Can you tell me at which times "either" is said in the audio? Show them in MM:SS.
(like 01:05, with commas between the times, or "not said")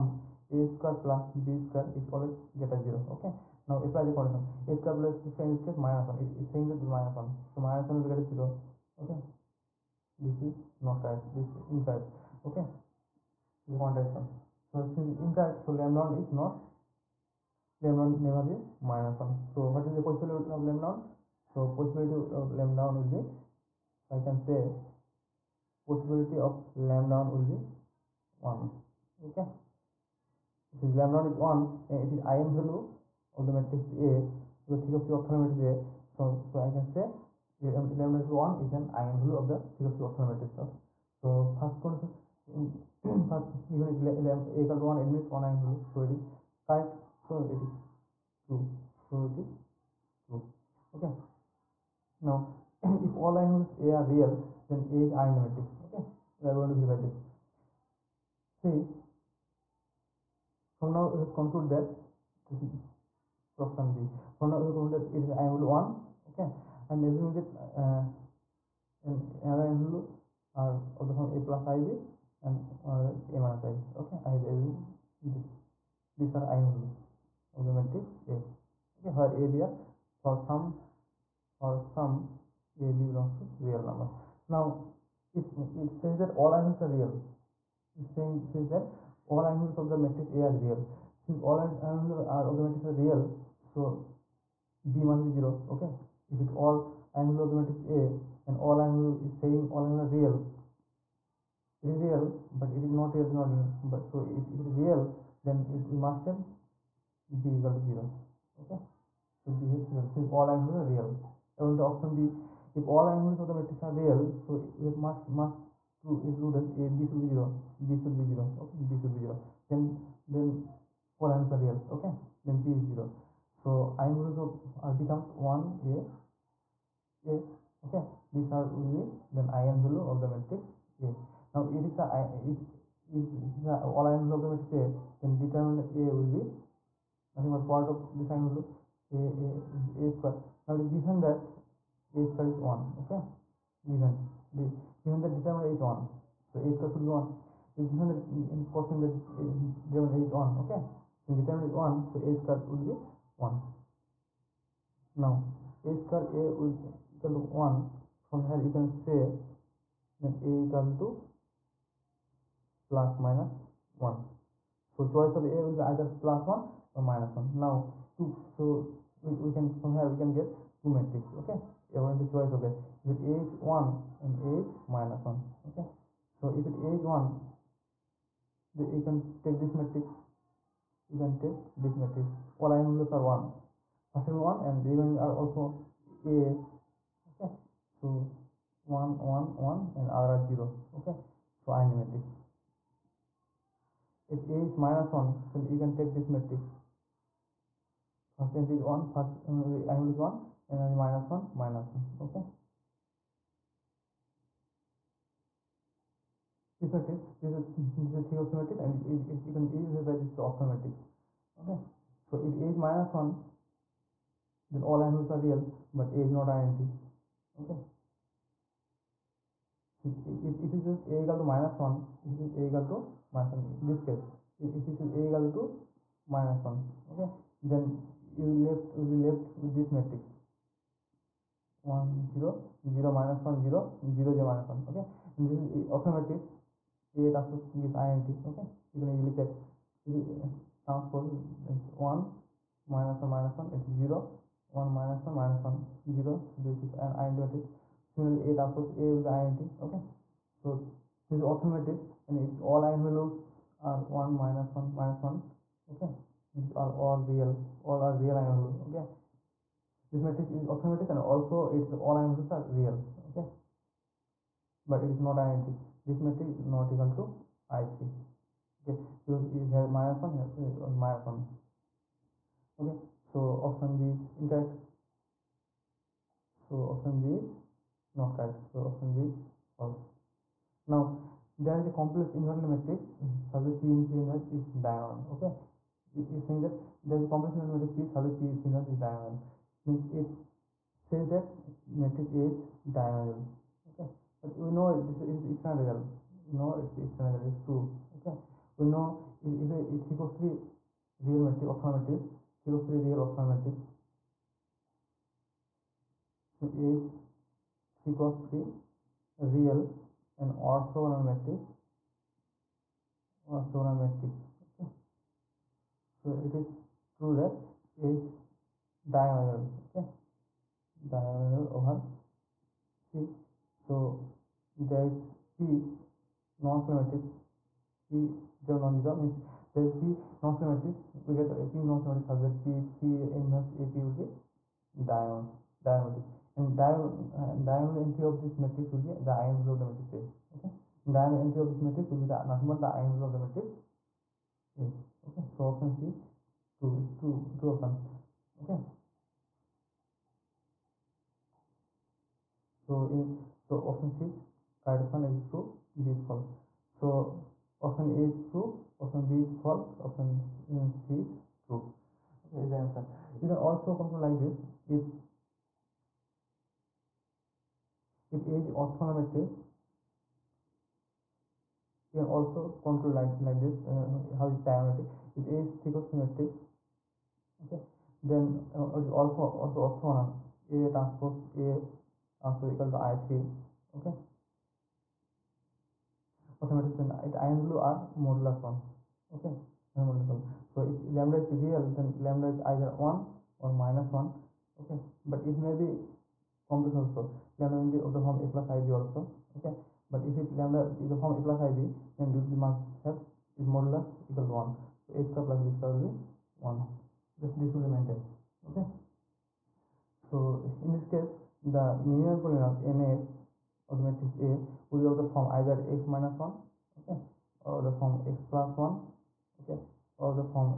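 02:45, 06:32, 06:55.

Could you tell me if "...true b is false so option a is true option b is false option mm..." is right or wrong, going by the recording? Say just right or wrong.
right.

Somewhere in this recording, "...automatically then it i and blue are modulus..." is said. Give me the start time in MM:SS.
06:26.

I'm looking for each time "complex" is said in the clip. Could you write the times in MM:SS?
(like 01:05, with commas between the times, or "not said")
04:41, 04:47, 06:36.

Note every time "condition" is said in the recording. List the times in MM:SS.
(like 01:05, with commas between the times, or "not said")
00:04, 00:41.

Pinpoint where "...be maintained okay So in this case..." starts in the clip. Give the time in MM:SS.
06:47.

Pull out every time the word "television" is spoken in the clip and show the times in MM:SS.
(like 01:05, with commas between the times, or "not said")
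not said.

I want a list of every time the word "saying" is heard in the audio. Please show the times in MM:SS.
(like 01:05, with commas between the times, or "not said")
00:06, 01:28, 01:39, 04:46.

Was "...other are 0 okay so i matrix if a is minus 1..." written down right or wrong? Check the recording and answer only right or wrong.
right.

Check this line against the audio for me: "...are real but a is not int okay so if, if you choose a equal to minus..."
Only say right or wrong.
right.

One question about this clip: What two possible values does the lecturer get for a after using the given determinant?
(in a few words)
plus or minus 1.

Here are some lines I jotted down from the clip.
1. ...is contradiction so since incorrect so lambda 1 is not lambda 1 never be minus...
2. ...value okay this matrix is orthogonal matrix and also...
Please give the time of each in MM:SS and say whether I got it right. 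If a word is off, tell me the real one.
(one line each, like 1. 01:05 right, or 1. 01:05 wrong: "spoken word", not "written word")
1. 00:13 right
2. 04:18 right.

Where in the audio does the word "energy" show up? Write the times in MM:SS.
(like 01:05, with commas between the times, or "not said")
03:20.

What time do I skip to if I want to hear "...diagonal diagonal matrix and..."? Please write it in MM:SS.
05:35.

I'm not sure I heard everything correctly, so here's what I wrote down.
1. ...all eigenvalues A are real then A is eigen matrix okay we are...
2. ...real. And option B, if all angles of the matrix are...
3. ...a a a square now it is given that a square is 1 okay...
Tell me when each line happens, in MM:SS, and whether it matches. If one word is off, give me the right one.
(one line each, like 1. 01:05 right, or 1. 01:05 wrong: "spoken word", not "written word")
1. 00:53 right
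2. 01:50 right
3. 02:19 right.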